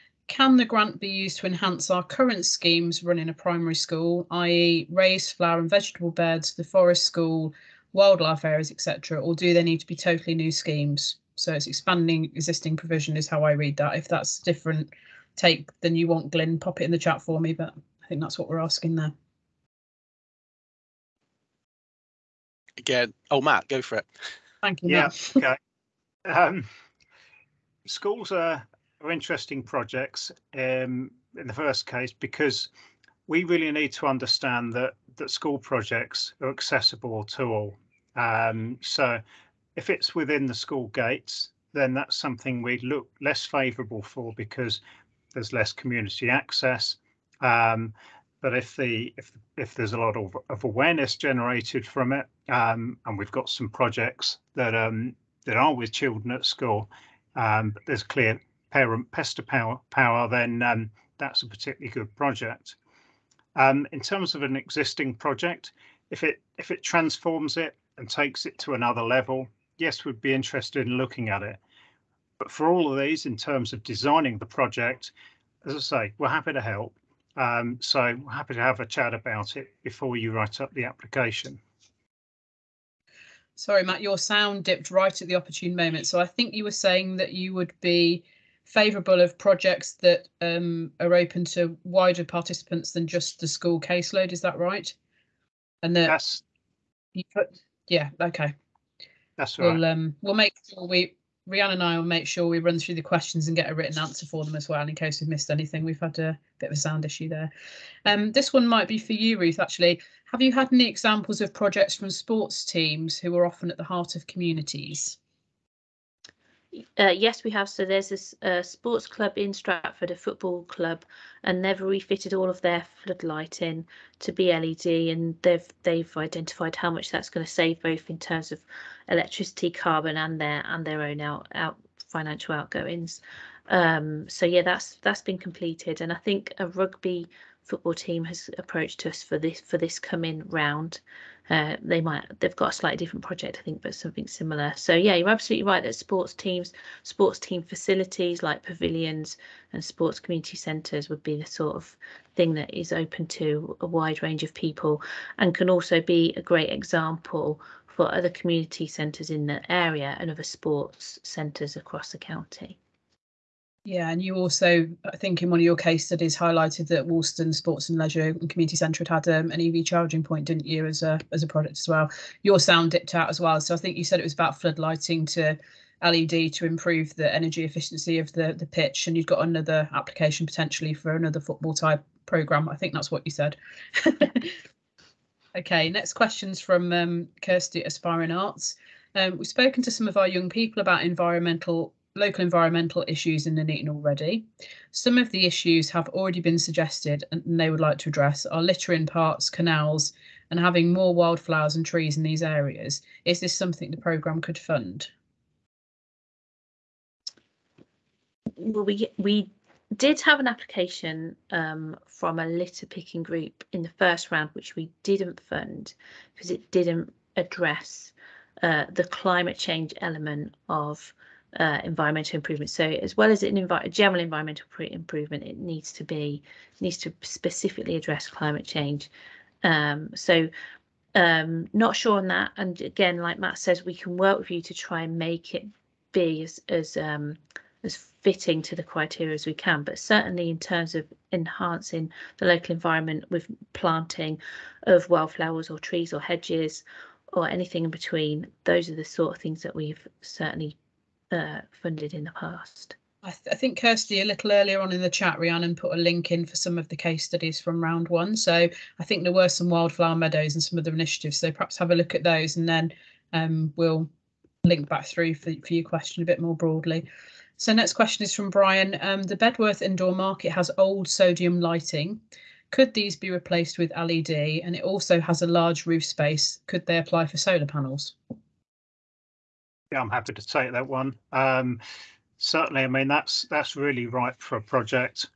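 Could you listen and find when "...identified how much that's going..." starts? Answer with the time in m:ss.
2:06.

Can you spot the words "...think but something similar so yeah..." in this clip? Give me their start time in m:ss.
2:23.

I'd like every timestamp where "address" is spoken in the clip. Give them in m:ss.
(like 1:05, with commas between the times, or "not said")
3:18, 3:37, 3:47.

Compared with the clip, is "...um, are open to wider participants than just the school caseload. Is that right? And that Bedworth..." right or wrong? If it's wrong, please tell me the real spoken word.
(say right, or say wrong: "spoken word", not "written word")
wrong: "You", not "Bedworth".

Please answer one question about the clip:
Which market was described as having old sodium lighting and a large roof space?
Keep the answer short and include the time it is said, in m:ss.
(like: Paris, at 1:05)
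Bedworth indoor market, at 4:29.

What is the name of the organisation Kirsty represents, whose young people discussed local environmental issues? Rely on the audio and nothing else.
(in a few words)
Aspiring Arts.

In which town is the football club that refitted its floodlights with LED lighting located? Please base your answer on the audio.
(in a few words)
Stratford.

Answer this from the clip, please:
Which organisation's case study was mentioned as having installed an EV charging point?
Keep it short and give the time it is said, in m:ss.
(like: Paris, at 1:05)
Wolston Sports and Leisure and Community Centre, at 2:47.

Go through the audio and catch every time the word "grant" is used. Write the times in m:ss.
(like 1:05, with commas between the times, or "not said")
0:00.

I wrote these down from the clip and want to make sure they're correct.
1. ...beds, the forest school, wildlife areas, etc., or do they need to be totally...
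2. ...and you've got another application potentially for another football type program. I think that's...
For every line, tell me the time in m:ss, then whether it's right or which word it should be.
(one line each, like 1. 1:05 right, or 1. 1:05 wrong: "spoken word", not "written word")
1. 0:06 right
2. 2:59 right.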